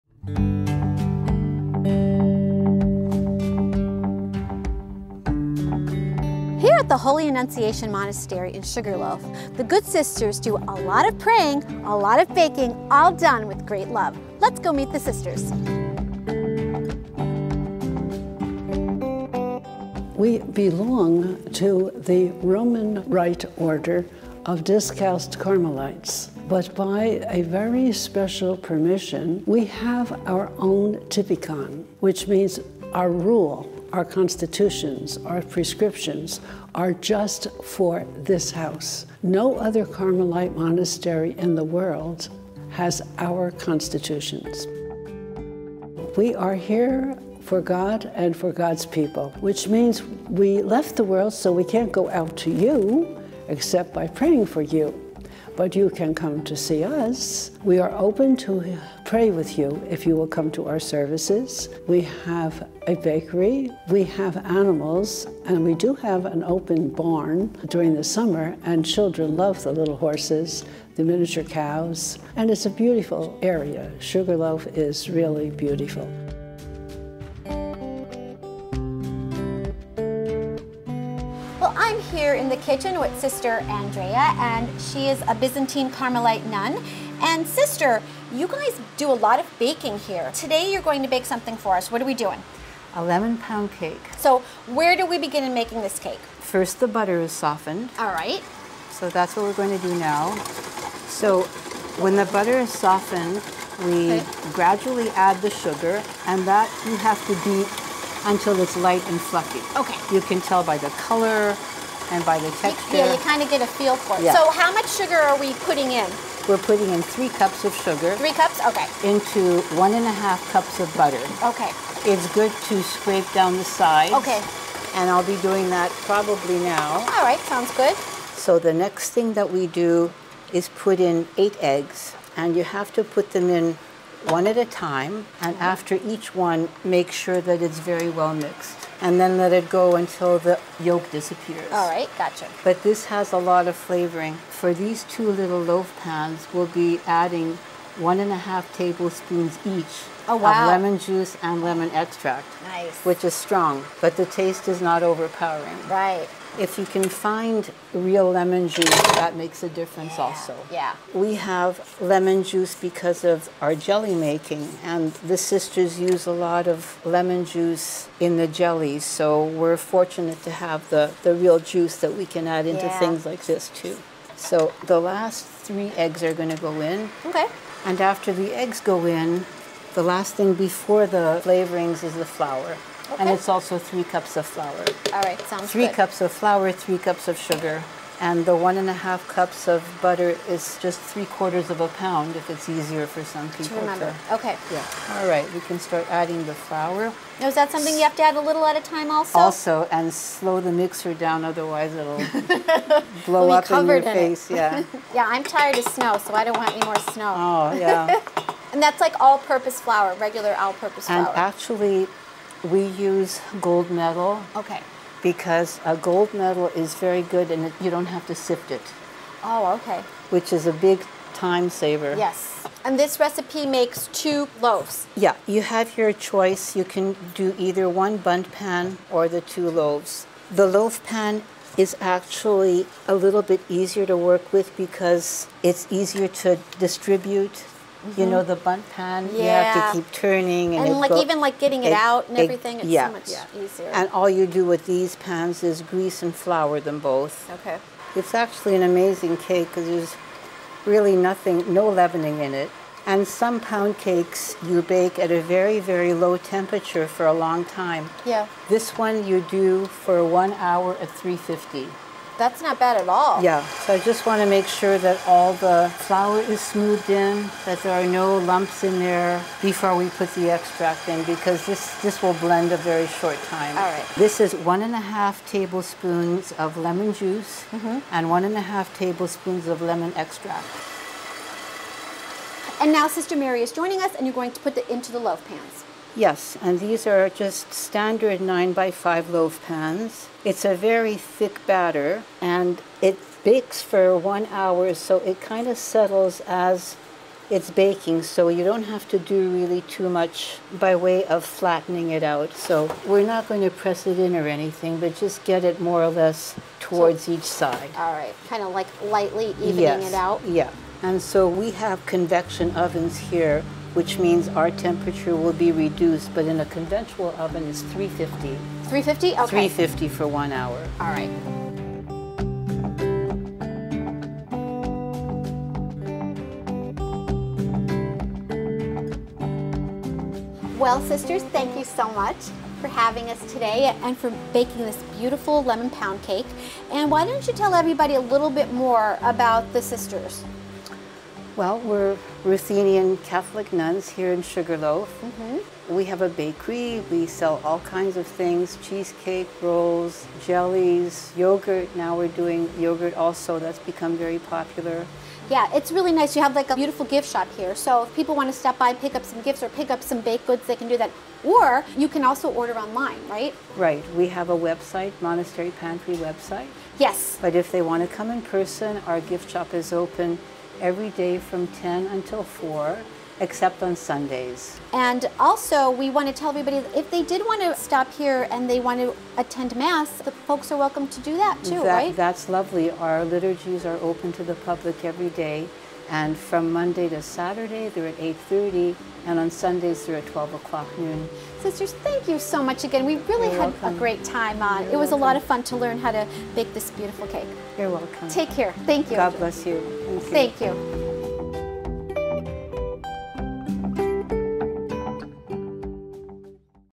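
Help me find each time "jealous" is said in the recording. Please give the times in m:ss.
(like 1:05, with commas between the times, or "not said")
not said.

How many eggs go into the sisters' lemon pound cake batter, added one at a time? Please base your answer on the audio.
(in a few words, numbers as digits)
8.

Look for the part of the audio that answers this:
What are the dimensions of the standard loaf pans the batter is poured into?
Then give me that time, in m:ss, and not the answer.
4:48.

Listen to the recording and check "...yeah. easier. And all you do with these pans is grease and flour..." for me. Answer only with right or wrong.
right.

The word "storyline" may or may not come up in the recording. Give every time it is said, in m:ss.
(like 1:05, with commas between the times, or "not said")
not said.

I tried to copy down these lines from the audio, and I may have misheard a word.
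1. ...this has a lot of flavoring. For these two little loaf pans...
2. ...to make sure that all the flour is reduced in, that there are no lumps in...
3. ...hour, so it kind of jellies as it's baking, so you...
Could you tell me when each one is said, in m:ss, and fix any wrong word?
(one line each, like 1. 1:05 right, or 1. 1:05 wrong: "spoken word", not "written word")
1. 2:22 right
2. 4:24 wrong: "smoothed", not "reduced"
3. 4:54 wrong: "settles", not "jellies".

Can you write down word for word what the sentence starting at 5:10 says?
Yeah, and so we have convection ovens here which means our temperature will be reduced, but in a conventional oven it's 350.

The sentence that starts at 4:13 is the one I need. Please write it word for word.
And some pound cakes you bake at a very, very low temperature for a long time.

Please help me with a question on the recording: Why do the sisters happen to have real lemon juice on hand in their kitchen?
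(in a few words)
jelly making.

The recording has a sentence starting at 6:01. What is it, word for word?
Or you can also order online, right?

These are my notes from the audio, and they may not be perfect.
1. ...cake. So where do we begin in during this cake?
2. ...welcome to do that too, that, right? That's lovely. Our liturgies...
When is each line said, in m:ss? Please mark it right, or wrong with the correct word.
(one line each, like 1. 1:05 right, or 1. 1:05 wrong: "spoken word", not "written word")
1. 1:33 wrong: "making", not "during"
2. 6:20 right.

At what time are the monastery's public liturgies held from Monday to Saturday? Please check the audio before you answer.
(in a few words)
8:30.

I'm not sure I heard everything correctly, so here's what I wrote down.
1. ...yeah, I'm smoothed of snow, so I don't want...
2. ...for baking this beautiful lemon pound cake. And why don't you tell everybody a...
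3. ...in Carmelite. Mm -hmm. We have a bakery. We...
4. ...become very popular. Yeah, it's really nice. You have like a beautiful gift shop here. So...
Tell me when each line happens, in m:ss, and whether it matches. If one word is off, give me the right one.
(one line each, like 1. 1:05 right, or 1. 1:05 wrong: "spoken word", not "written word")
1. 3:25 wrong: "tired", not "smoothed"
2. 5:34 right
3. 5:44 wrong: "Sugarloaf", not "Carmelite"
4. 5:53 right.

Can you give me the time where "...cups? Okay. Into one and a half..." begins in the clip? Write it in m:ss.
1:58.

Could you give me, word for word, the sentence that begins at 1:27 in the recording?
And Sister, you guys do a lot of baking here.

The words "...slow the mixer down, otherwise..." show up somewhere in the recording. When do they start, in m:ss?
3:20.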